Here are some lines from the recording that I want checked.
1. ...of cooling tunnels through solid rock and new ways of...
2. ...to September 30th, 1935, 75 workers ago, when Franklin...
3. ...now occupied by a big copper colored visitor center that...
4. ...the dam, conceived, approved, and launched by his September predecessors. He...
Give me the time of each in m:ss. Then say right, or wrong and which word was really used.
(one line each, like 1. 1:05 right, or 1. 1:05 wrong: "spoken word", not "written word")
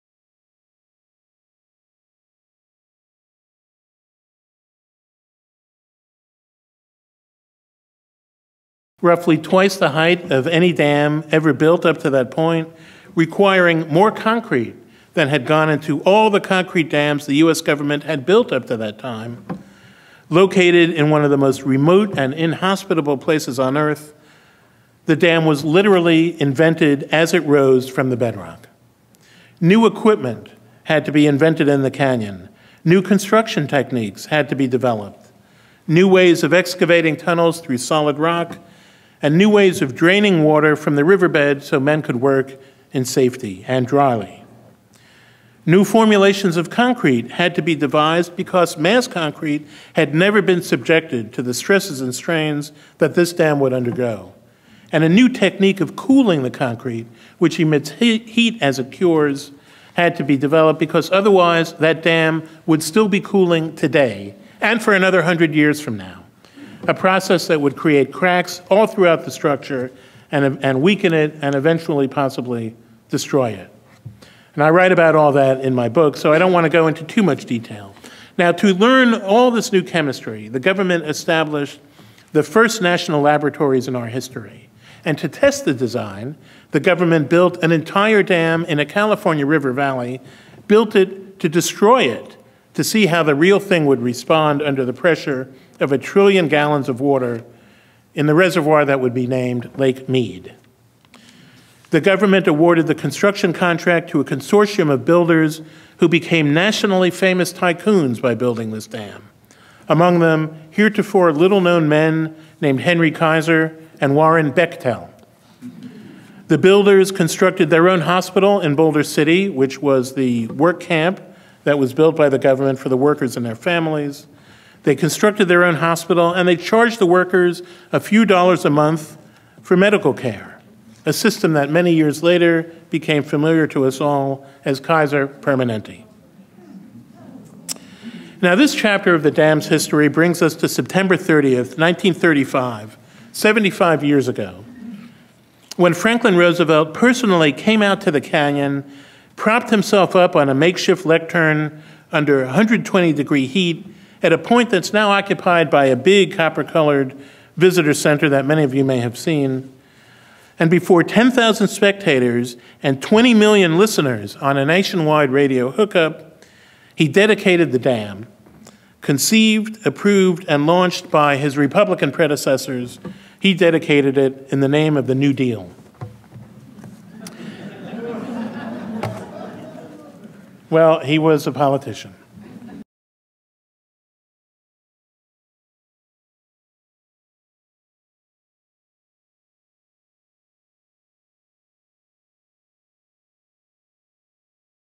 1. 0:36 wrong: "excavating", not "cooling"
2. 2:20 wrong: "years", not "workers"
3. 2:34 right
4. 2:47 wrong: "Republican", not "September".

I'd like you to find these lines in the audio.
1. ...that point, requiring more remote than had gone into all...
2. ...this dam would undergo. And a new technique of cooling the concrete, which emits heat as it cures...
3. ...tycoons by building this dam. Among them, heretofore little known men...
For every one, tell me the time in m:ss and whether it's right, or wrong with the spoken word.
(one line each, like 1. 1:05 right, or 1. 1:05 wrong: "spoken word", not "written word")
1. 0:12 wrong: "concrete", not "remote"
2. 0:53 right
3. 1:47 right.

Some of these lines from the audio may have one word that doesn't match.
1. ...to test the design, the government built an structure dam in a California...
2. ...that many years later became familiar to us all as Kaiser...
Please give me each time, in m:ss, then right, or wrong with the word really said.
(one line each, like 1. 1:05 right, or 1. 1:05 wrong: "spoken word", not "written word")
1. 1:25 wrong: "entire", not "structure"
2. 2:11 right.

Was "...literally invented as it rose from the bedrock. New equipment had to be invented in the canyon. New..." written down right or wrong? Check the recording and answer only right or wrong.
right.